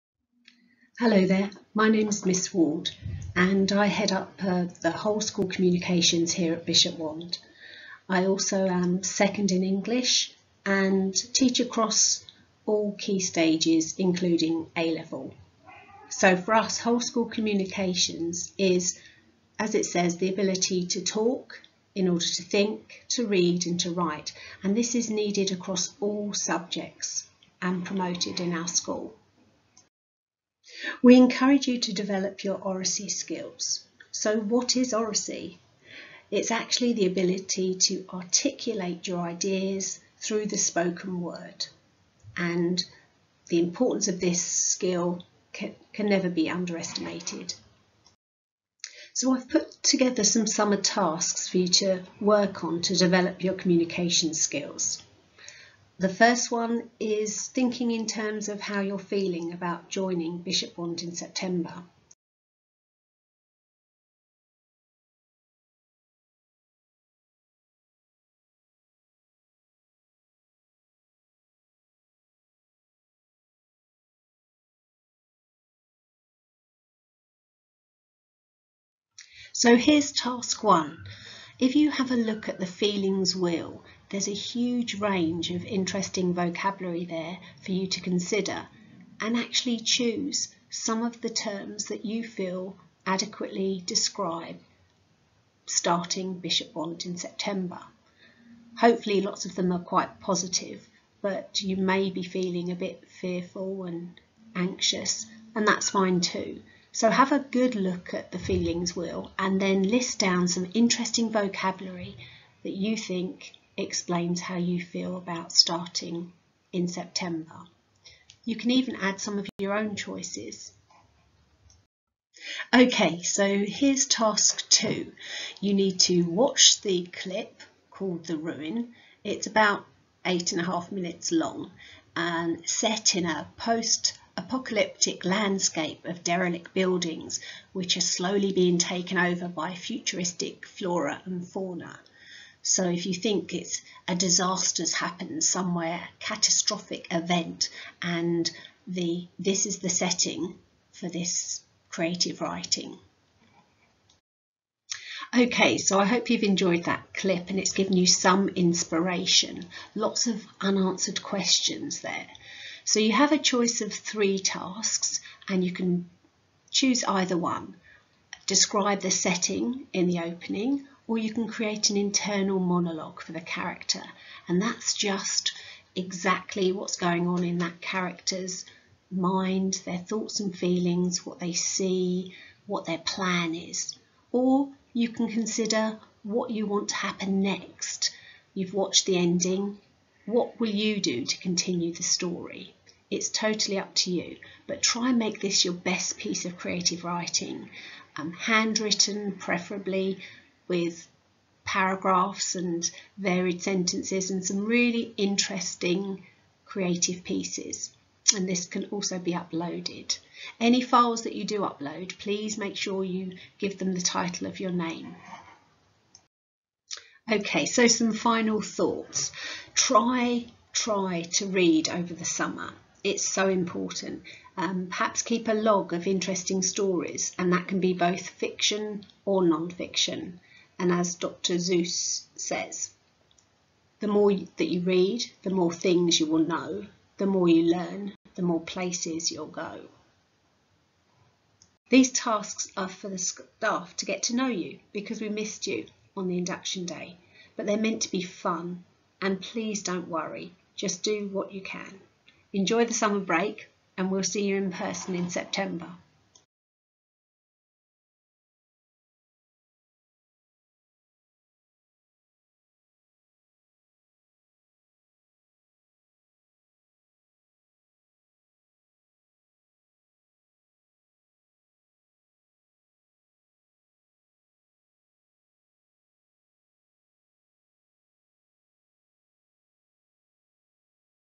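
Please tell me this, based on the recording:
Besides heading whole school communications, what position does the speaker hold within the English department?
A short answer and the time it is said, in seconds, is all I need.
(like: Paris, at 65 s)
Second in English, at 9 s.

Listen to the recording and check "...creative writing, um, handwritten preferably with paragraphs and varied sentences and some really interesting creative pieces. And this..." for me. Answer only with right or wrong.
right.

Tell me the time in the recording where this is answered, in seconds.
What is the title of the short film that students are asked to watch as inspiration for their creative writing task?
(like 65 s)
128 s.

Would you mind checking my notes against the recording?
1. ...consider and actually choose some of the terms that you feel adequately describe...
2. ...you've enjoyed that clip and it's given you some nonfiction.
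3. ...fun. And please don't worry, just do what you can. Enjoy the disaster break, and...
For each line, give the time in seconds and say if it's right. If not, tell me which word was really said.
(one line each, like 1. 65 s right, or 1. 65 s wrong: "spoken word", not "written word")
1. 88 s right
2. 156 s wrong: "inspiration", not "nonfiction"
3. 248 s wrong: "summer", not "disaster".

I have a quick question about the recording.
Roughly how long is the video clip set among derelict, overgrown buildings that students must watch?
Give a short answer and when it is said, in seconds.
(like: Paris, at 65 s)
8.5 minutes, at 130 s.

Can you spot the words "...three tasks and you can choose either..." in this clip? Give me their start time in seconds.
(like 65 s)
163 s.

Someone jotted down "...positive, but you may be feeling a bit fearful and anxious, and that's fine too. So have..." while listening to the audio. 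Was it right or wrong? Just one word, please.
right.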